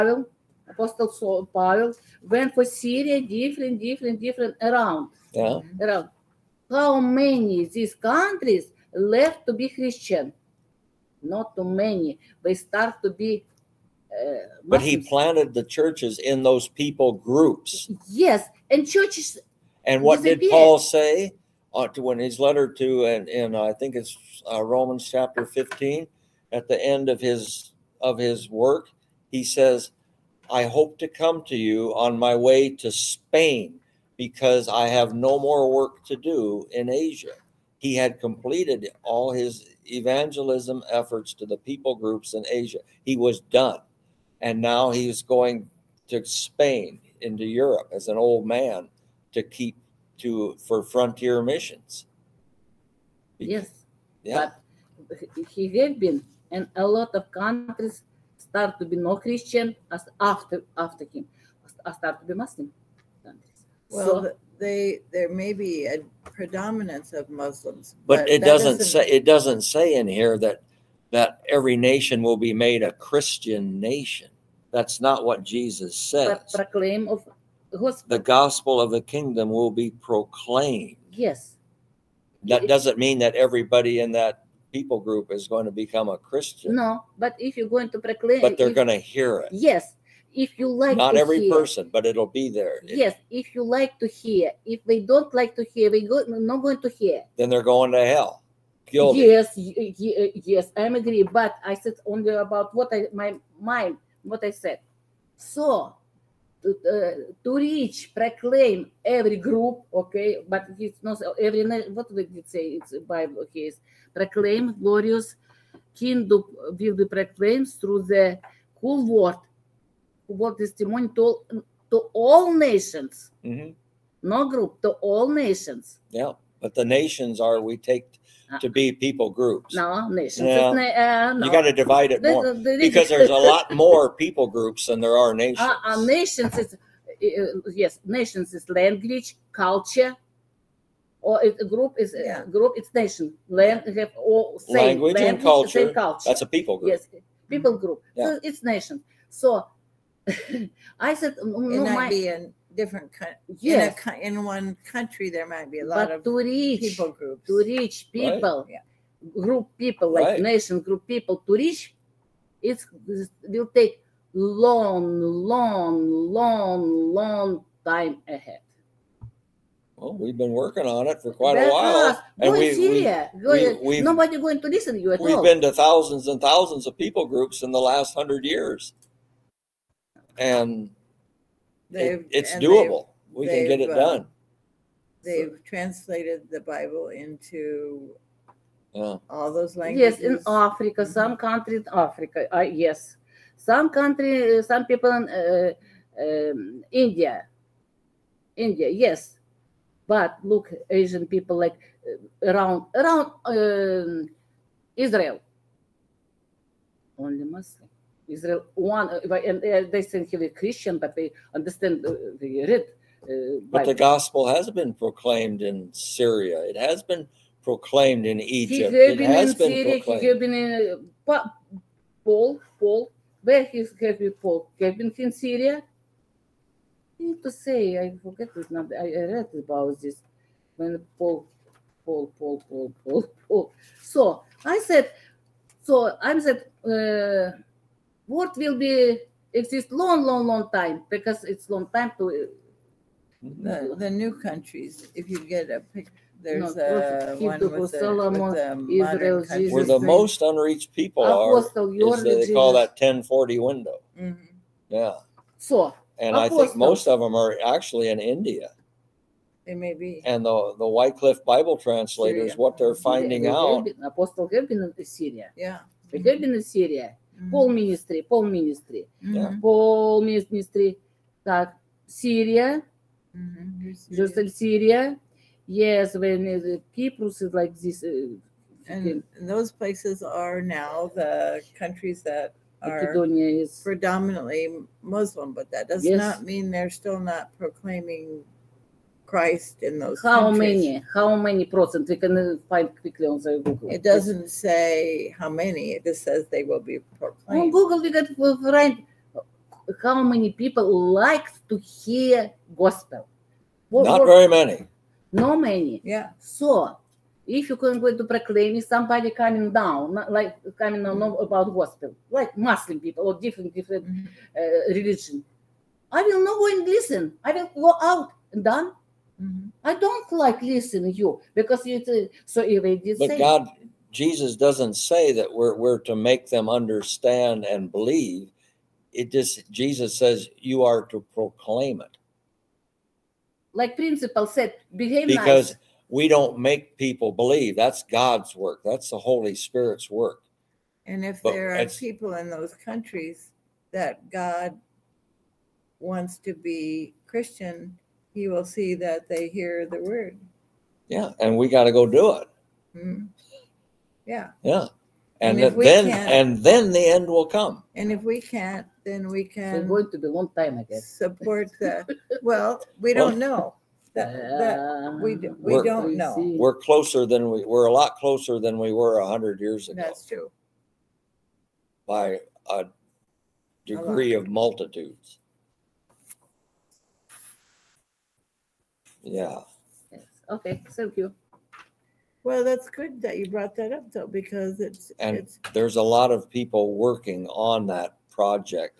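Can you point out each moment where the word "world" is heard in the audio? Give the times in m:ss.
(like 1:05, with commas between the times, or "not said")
1:59, 3:58.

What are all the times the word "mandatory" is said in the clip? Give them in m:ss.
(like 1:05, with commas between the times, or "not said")
not said.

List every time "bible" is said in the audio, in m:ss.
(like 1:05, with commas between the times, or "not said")
1:53, 3:06, 4:21.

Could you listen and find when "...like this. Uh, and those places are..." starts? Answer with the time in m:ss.
4:37.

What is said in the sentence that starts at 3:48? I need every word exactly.
I, read about this when Paul, Paul, Paul, Paul, Paul, Paul.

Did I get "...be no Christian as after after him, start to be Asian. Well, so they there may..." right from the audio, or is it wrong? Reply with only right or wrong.
wrong.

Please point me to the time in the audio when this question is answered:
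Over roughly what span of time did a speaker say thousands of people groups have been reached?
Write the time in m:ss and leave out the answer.
2:57.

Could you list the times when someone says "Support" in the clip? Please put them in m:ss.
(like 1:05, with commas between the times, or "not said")
6:01.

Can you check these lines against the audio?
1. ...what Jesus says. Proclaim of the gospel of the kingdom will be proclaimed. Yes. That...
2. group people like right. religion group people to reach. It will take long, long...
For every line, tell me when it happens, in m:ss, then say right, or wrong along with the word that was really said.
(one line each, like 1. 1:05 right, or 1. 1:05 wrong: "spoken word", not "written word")
1. 1:15 right
2. 2:39 wrong: "nation", not "religion".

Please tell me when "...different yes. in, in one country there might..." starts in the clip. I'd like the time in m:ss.
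2:32.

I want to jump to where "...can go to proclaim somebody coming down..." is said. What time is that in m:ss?
5:07.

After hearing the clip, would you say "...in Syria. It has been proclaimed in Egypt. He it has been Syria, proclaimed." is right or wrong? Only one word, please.
right.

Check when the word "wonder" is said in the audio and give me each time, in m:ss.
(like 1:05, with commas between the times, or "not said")
not said.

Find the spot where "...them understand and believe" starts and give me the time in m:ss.
5:26.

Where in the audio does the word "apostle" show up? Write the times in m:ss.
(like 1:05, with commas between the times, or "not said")
0:00, 4:16, 4:24.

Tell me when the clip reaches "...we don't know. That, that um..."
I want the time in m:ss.
6:02.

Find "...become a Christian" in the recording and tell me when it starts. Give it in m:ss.
1:25.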